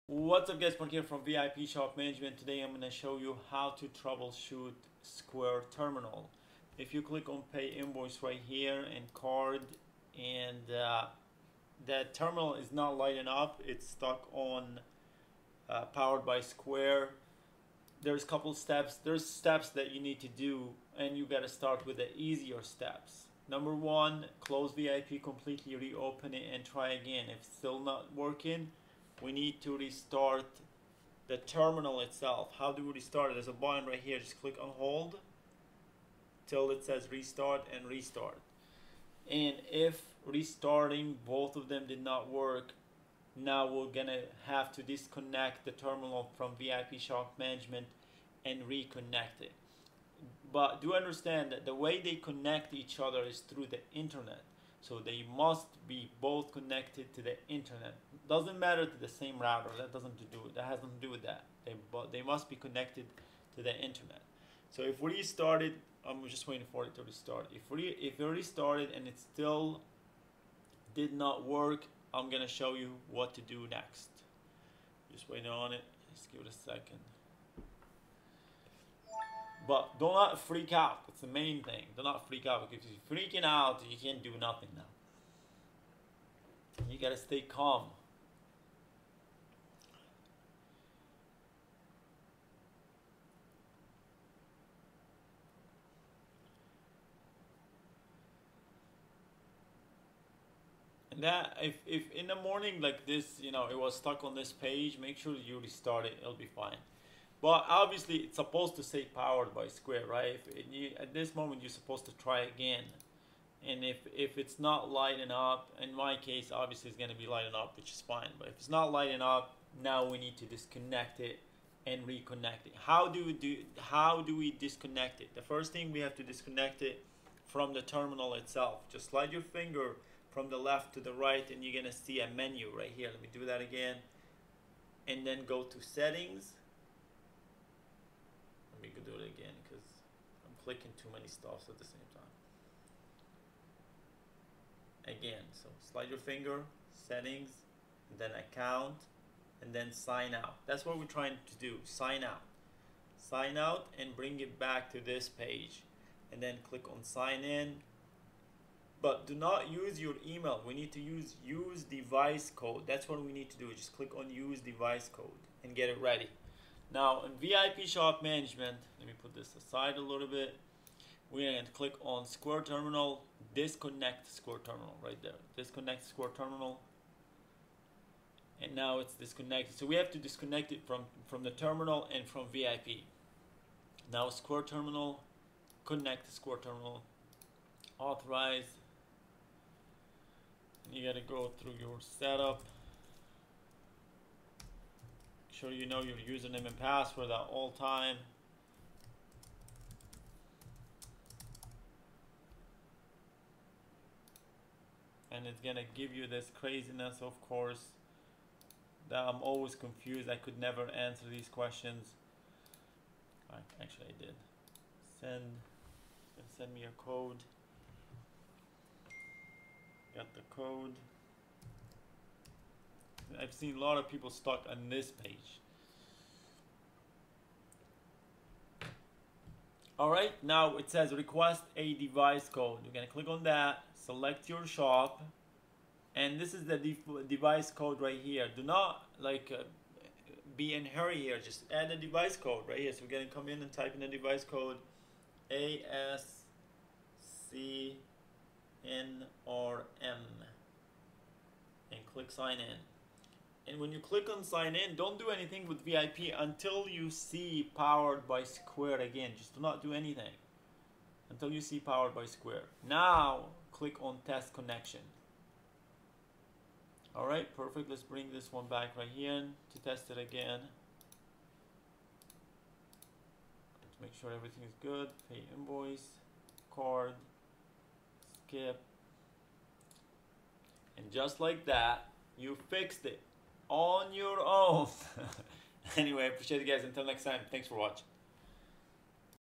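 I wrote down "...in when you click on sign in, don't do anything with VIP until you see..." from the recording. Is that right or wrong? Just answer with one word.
right.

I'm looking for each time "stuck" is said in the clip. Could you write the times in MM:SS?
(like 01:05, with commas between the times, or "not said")
00:13, 01:43, 03:44.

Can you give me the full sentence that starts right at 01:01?
They they must be connected to the internet.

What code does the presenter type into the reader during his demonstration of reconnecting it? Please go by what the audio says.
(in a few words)
ASCNRM.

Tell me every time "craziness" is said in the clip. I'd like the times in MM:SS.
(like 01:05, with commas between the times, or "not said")
03:26.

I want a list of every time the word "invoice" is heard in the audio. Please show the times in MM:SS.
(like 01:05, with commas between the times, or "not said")
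00:07, 04:35.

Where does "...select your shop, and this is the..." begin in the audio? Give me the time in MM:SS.
03:53.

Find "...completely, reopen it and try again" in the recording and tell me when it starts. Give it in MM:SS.
00:25.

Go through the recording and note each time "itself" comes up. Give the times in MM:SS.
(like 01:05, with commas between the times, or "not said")
00:32, 02:08.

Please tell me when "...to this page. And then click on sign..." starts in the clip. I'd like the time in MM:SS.
02:34.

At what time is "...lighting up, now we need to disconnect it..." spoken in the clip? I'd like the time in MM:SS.
01:58.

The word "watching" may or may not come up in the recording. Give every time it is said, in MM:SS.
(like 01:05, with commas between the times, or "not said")
04:47.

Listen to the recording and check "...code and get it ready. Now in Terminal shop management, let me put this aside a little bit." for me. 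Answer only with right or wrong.
wrong.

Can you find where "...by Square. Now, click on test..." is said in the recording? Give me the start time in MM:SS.
04:22.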